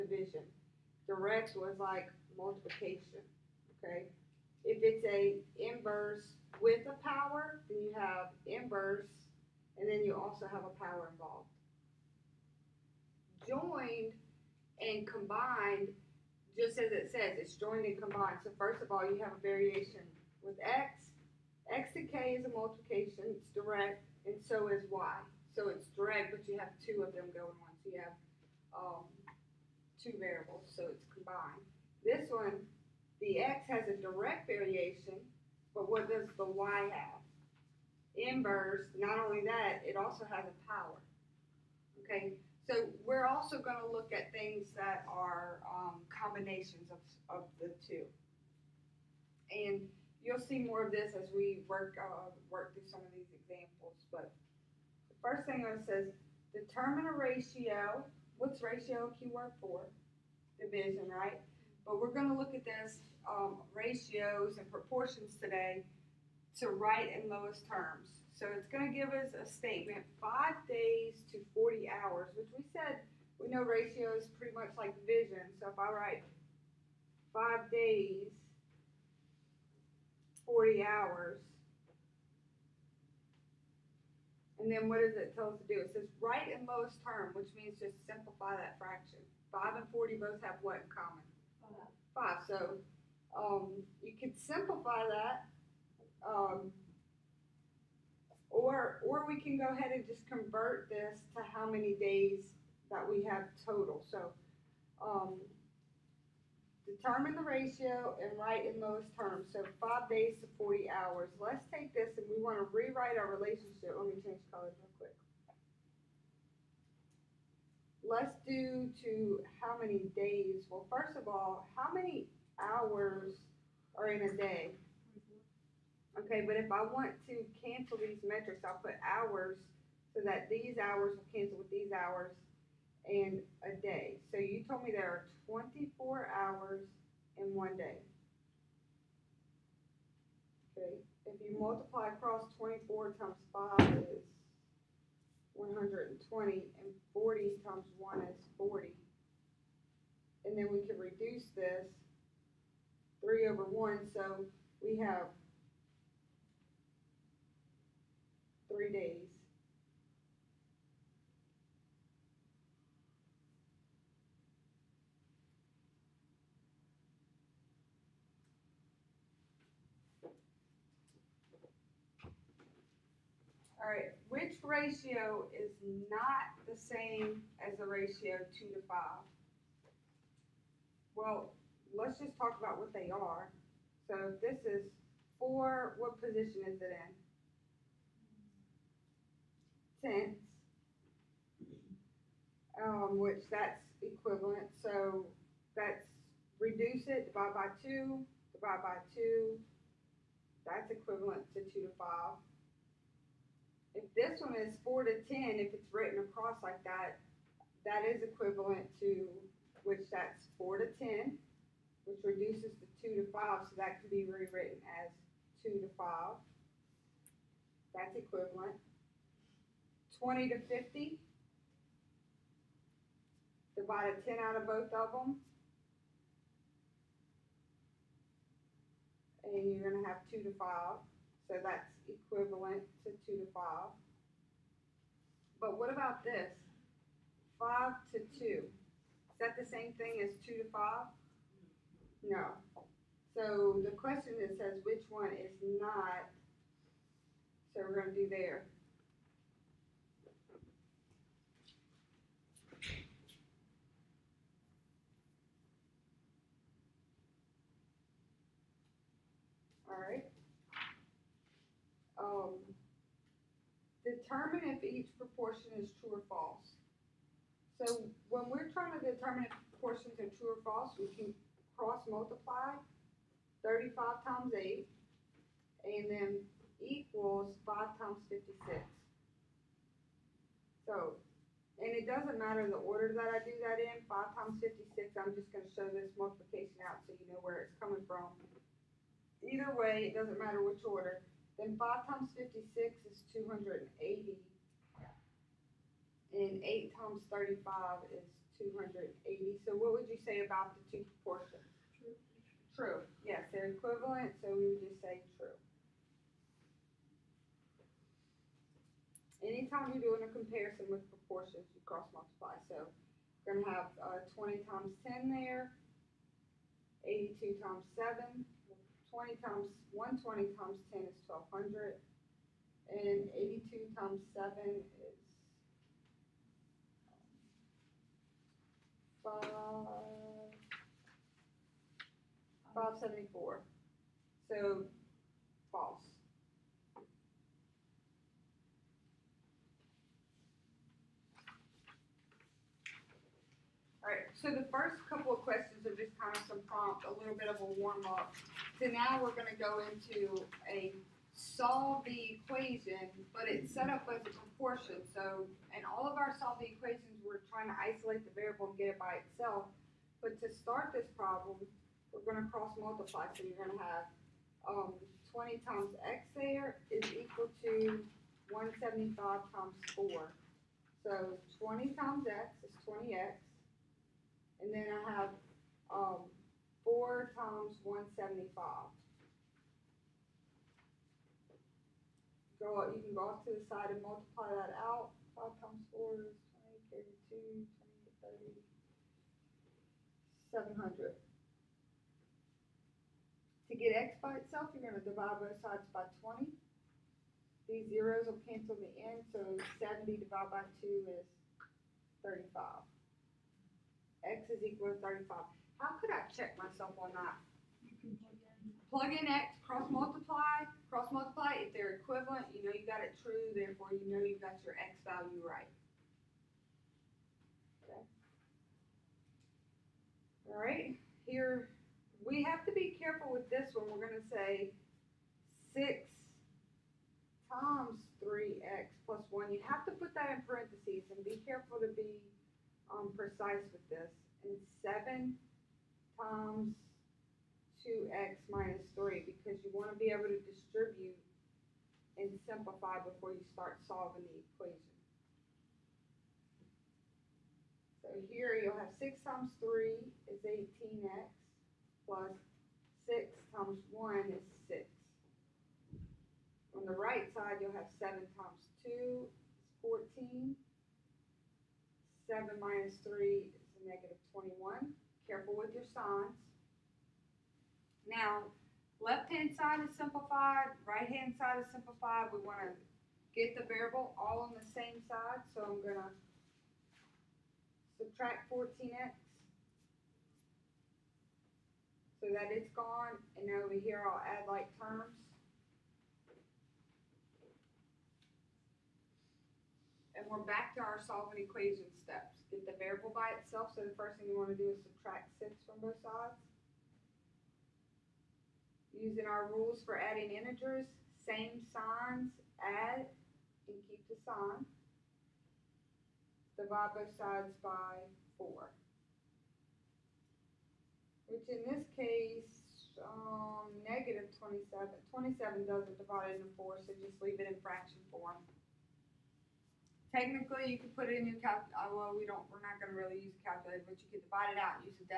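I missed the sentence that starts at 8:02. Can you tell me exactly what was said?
So that it's gone, and over here I'll add like terms.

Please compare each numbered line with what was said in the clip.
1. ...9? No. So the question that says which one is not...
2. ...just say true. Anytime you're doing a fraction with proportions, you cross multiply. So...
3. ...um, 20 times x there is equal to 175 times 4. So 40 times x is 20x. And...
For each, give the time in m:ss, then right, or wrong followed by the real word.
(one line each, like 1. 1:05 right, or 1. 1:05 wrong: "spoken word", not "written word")
1. 4:00 wrong: "5", not "9"
2. 5:04 wrong: "comparison", not "fraction"
3. 6:04 wrong: "20", not "40".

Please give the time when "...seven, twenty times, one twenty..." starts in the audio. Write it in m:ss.
5:17.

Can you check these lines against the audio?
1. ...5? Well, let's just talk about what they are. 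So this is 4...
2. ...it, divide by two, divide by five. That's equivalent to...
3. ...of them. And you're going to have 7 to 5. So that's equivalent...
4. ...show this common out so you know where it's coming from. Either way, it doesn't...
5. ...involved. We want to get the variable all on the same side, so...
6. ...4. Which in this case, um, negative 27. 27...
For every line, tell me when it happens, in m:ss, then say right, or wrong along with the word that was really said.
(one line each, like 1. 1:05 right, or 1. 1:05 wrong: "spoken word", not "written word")
1. 2:58 right
2. 3:17 wrong: "two", not "five"
3. 3:44 wrong: "2", not "7"
4. 4:45 wrong: "multiplication", not "common"
5. 7:51 wrong: "simplified", not "involved"
6. 8:28 right.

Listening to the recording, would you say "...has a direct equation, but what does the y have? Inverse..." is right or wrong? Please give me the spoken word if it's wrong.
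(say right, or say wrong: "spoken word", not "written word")
wrong: "variation", not "equation".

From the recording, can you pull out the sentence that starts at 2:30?
And then we can reduce this 3 over 1, so we have three days.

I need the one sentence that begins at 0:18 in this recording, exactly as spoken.
So first of all, you have a variation with x.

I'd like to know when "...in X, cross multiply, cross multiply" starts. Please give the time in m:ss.
6:49.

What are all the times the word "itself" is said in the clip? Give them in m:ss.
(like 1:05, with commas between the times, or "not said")
5:59, 6:34, 8:13.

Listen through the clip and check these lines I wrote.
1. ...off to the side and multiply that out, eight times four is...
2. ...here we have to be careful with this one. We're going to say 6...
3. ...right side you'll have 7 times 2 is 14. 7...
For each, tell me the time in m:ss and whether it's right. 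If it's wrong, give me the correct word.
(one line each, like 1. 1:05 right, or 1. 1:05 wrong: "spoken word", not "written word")
1. 6:23 wrong: "five", not "eight"
2. 7:01 right
3. 7:36 right.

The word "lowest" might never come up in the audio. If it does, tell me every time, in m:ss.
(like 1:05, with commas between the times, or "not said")
1:07, 1:26, 1:48.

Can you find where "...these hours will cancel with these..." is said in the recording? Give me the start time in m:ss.
2:10.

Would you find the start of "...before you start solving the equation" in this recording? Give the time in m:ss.
7:23.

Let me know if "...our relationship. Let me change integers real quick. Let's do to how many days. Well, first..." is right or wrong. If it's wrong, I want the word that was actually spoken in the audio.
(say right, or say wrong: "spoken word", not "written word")
wrong: "colors", not "integers".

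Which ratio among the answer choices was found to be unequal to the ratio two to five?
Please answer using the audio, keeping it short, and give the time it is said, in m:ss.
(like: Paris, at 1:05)
5 to 2, at 3:57.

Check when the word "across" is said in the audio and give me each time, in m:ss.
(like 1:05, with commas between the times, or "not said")
2:22, 3:26.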